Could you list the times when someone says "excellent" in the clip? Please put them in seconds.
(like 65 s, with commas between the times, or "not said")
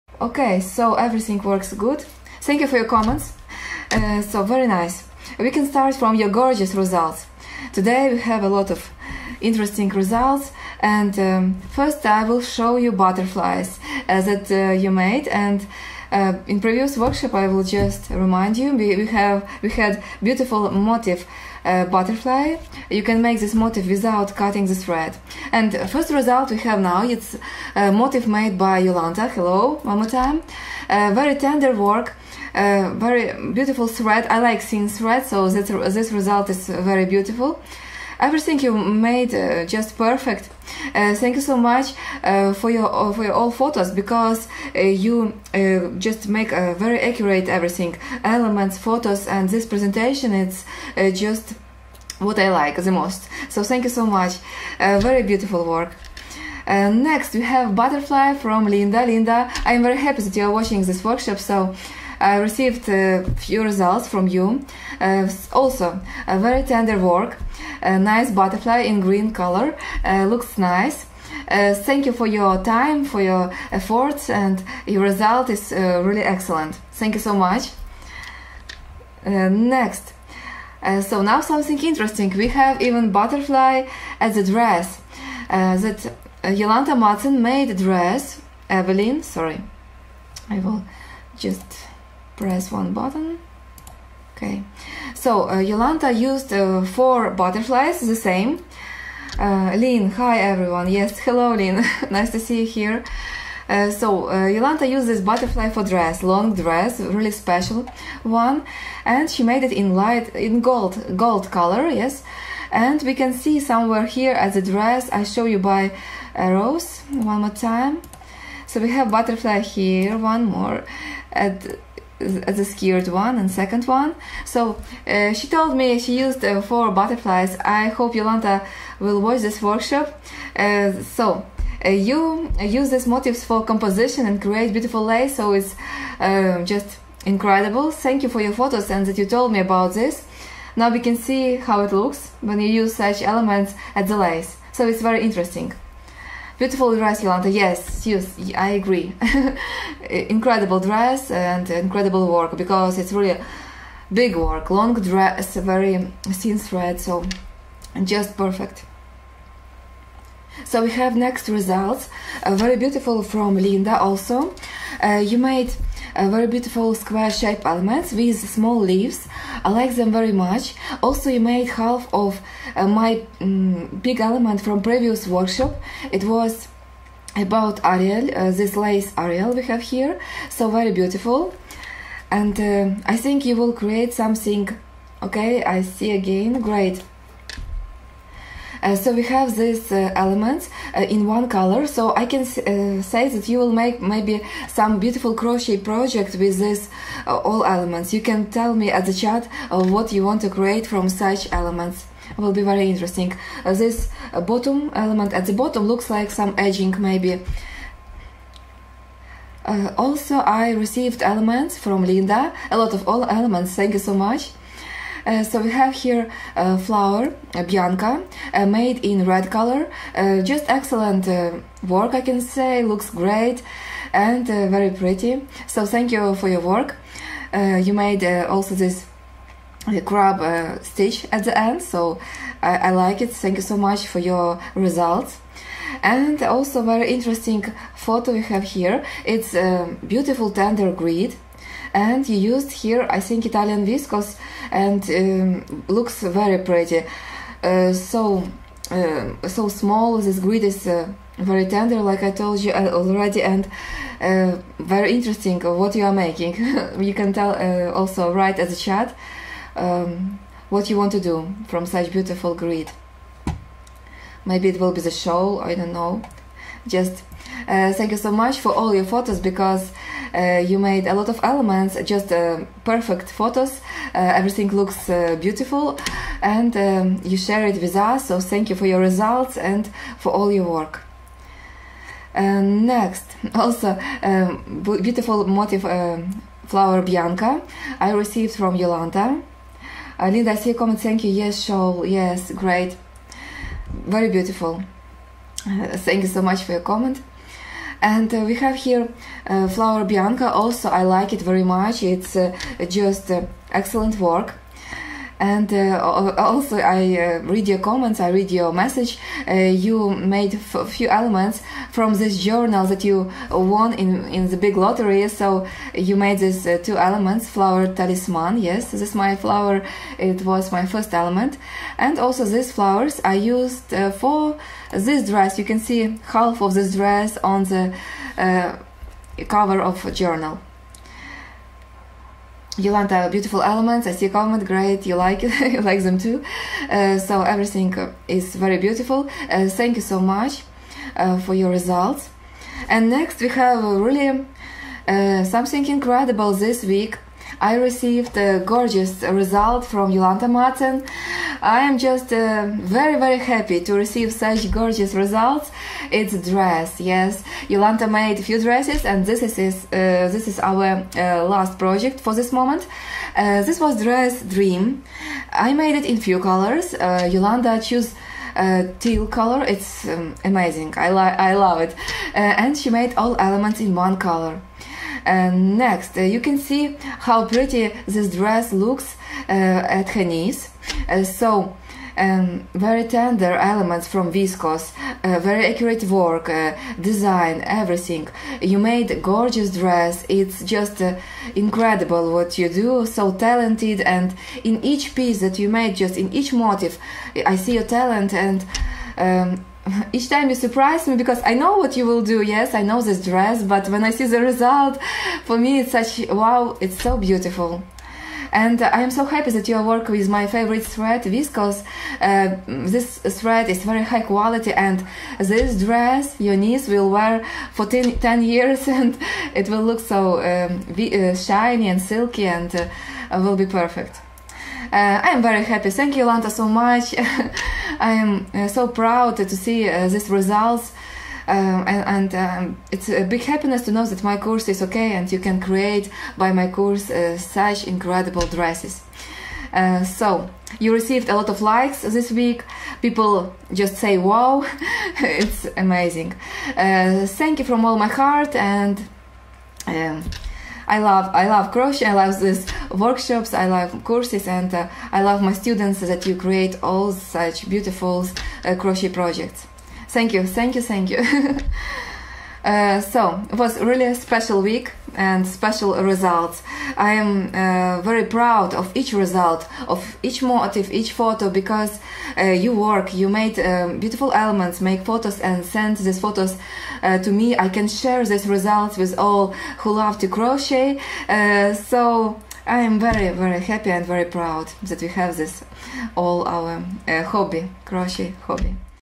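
76 s, 220 s, 303 s.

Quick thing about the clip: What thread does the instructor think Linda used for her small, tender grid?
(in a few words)
Italian viscose.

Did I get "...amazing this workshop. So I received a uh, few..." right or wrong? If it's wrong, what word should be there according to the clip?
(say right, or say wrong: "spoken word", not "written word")
wrong: "watching", not "amazing".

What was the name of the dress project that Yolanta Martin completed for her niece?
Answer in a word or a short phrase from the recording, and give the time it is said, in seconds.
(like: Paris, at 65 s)
Dream, at 364 s.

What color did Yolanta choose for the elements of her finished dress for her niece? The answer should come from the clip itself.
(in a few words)
Teal.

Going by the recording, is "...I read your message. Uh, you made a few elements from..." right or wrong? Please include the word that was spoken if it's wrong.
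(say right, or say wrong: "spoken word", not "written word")
right.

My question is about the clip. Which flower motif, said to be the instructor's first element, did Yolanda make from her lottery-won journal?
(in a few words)
Flower talisman.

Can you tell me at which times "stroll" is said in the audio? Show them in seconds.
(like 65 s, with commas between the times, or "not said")
not said.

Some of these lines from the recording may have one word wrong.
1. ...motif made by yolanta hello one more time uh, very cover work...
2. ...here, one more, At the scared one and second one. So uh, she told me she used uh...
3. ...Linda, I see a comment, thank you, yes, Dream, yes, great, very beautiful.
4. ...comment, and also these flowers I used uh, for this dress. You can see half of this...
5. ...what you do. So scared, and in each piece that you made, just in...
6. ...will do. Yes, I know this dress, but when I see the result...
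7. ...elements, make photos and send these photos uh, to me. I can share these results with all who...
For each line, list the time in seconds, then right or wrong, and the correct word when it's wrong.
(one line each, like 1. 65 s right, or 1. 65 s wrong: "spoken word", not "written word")
1. 27 s wrong: "tender", not "cover"
2. 119 s right
3. 290 s wrong: "Shaul", not "Dream"
4. 321 s wrong: "element", not "comment"
5. 392 s wrong: "talented", not "scared"
6. 402 s right
7. 474 s right.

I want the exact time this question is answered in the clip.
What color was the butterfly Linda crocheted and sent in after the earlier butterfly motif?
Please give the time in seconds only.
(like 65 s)
69 s.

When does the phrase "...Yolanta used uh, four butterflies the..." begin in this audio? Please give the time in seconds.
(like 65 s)
95 s.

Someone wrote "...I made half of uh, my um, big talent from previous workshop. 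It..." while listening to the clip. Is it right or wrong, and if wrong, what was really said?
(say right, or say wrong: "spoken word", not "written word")
wrong: "element", not "talent".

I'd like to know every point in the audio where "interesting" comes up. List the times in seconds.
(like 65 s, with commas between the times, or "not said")
9 s, 81 s, 145 s, 202 s, 237 s, 255 s.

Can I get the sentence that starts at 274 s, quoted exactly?
Uh, everything looks beautiful, and um, you share it with us.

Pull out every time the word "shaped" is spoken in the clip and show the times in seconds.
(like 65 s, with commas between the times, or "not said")
167 s.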